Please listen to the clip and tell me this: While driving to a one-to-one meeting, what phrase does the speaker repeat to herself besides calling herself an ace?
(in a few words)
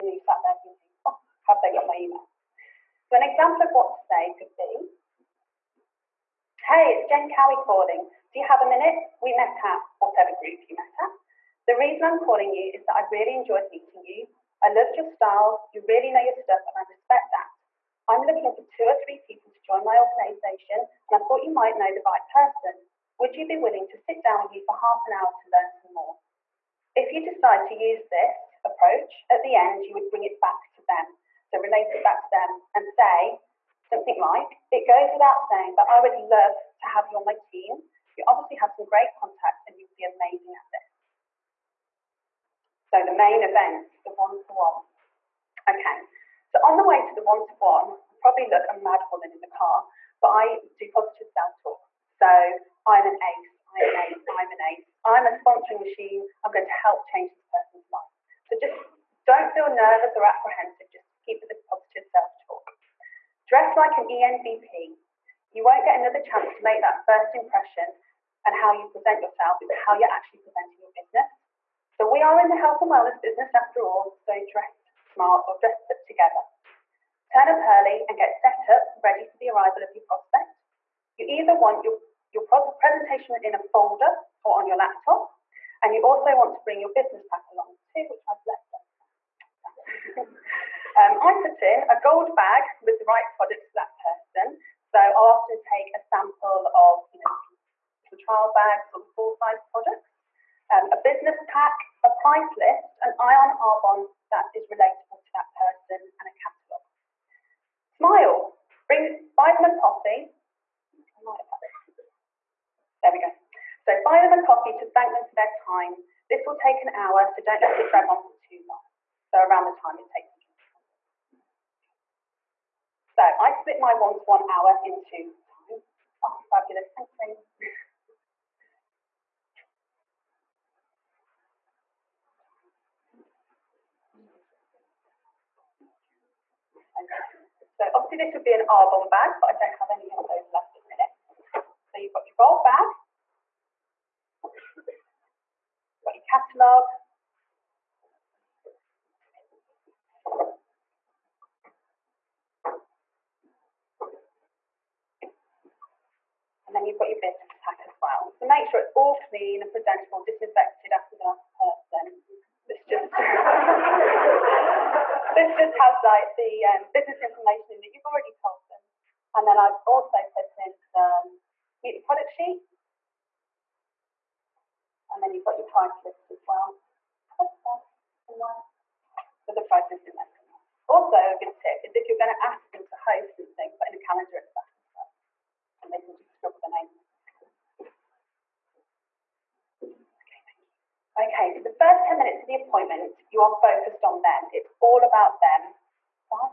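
Sponsoring machine.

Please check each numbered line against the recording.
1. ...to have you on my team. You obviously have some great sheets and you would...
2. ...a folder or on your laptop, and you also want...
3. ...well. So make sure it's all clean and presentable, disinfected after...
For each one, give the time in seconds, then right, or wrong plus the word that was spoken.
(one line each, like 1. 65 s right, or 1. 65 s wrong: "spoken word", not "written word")
1. 36 s wrong: "contacts", not "sheets"
2. 83 s right
3. 158 s right.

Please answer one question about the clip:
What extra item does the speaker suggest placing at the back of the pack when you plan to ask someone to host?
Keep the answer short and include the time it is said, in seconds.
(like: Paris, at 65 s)
A calendar, at 184 s.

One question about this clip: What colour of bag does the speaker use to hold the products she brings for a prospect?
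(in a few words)
Gold.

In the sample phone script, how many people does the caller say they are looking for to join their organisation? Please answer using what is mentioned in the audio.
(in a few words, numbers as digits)
2 or 3.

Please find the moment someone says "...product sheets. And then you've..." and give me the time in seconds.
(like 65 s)
172 s.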